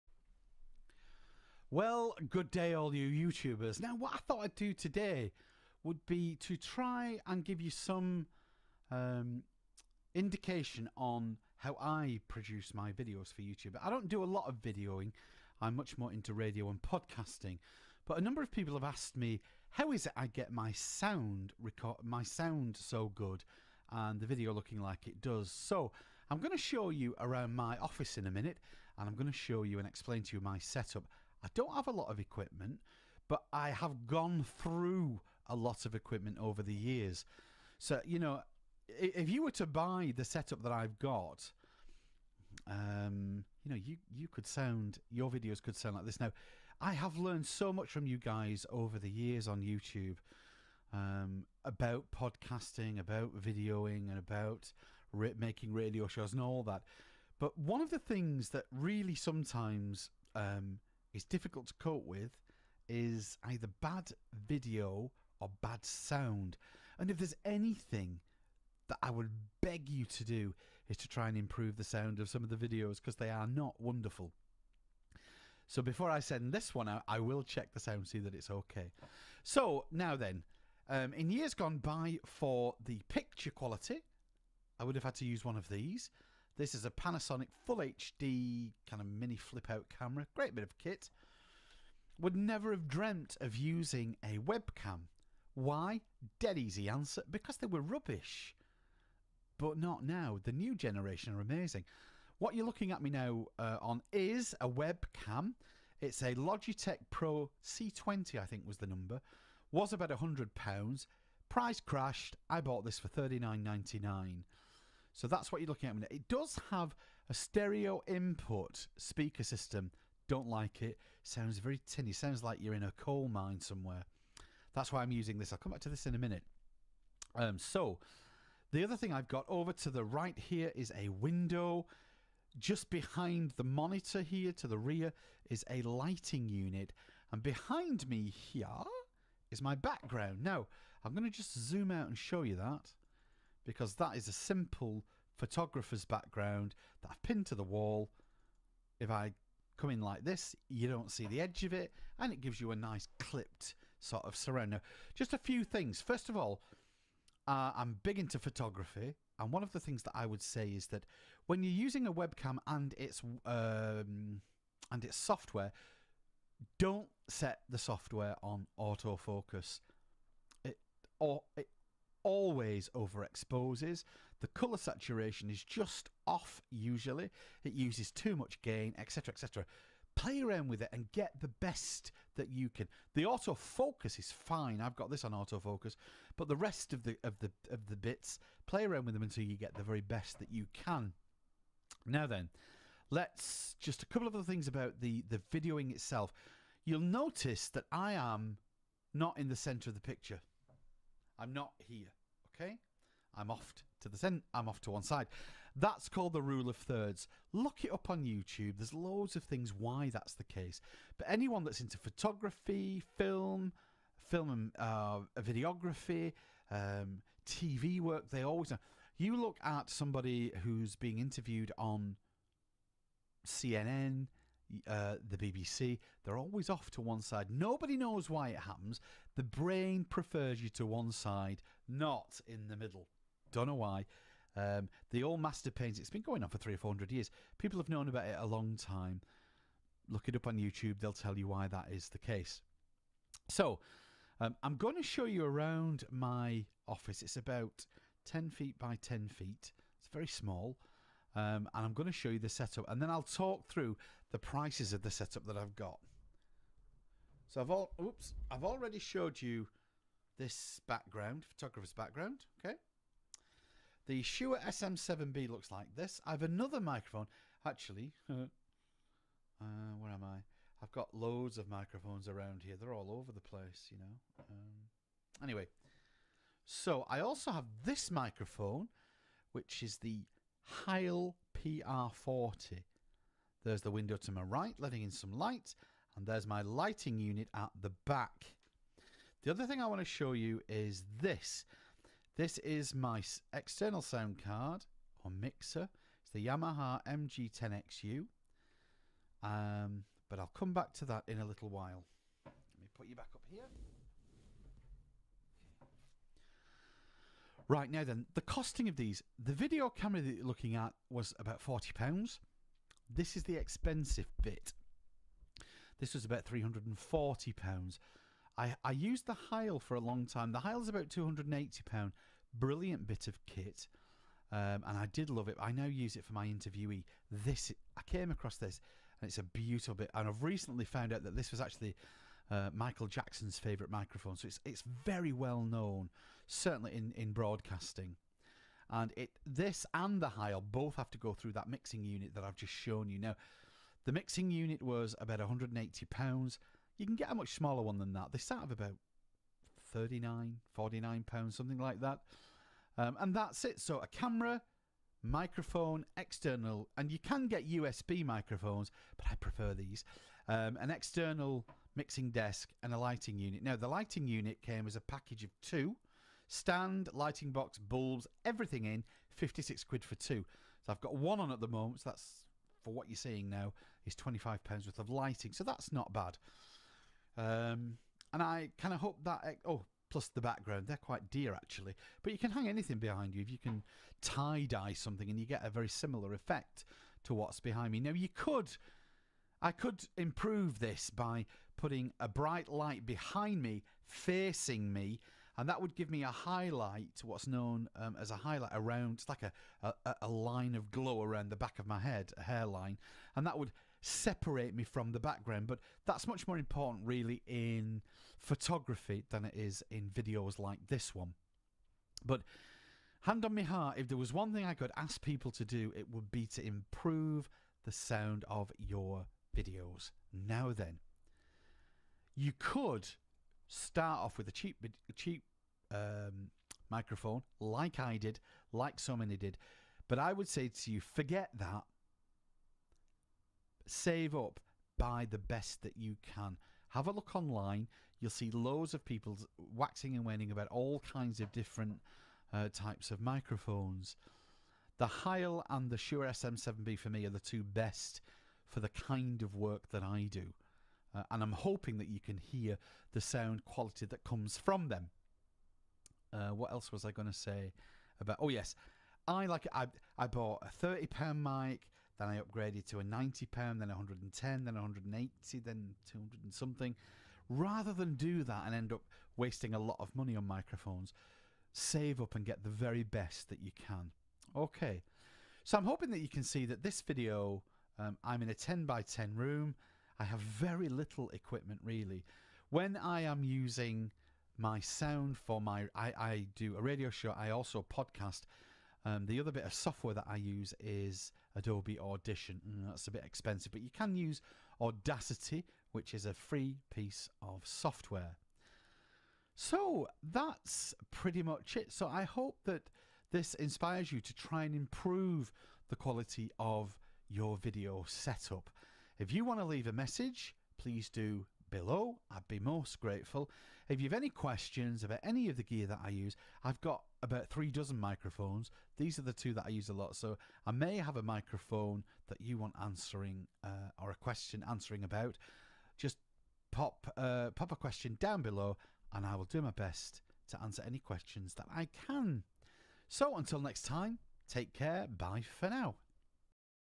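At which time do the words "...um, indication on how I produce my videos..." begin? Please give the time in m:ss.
0:08.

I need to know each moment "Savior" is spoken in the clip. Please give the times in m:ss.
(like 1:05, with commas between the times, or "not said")
not said.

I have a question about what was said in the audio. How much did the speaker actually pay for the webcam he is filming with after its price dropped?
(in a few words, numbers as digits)
£39.99.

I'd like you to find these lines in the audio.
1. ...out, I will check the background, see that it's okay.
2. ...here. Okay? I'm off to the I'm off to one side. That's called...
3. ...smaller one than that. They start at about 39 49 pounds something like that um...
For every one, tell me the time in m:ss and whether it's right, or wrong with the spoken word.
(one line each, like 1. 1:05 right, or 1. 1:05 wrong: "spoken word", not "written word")
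1. 1:16 wrong: "sound", not "background"
2. 3:21 right
3. 5:47 right.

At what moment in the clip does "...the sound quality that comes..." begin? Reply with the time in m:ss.
7:33.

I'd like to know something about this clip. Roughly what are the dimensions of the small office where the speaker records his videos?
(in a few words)
10 feet by 10 feet.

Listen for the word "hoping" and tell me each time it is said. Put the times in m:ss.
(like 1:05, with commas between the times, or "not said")
7:31, 7:55.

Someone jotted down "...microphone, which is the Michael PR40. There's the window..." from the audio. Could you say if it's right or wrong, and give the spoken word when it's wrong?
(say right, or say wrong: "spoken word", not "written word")
wrong: "Heil", not "Michael".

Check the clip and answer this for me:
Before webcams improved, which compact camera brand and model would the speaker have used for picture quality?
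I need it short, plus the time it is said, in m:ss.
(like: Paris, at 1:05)
Panasonic Full HD, at 1:26.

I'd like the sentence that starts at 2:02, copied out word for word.
Sounds like you're in a coal mine somewhere.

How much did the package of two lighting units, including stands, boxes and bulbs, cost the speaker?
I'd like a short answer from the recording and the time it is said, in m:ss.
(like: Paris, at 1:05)
£56, at 6:09.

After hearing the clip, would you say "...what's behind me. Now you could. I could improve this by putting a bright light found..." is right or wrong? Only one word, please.
wrong.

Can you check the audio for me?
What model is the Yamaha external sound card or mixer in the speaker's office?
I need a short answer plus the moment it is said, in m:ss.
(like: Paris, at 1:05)
MG10XU, at 4:57.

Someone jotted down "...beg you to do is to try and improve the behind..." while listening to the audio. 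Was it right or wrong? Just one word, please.
wrong.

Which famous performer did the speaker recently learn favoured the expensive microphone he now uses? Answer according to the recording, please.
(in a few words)
Michael Jackson.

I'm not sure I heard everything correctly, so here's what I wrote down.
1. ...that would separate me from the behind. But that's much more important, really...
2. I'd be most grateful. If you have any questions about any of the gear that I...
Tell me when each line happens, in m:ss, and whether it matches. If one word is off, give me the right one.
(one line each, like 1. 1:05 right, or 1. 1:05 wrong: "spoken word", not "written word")
1. 6:43 wrong: "background", not "behind"
2. 8:32 right.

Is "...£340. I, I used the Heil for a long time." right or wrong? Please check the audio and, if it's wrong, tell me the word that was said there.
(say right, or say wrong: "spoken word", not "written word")
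right.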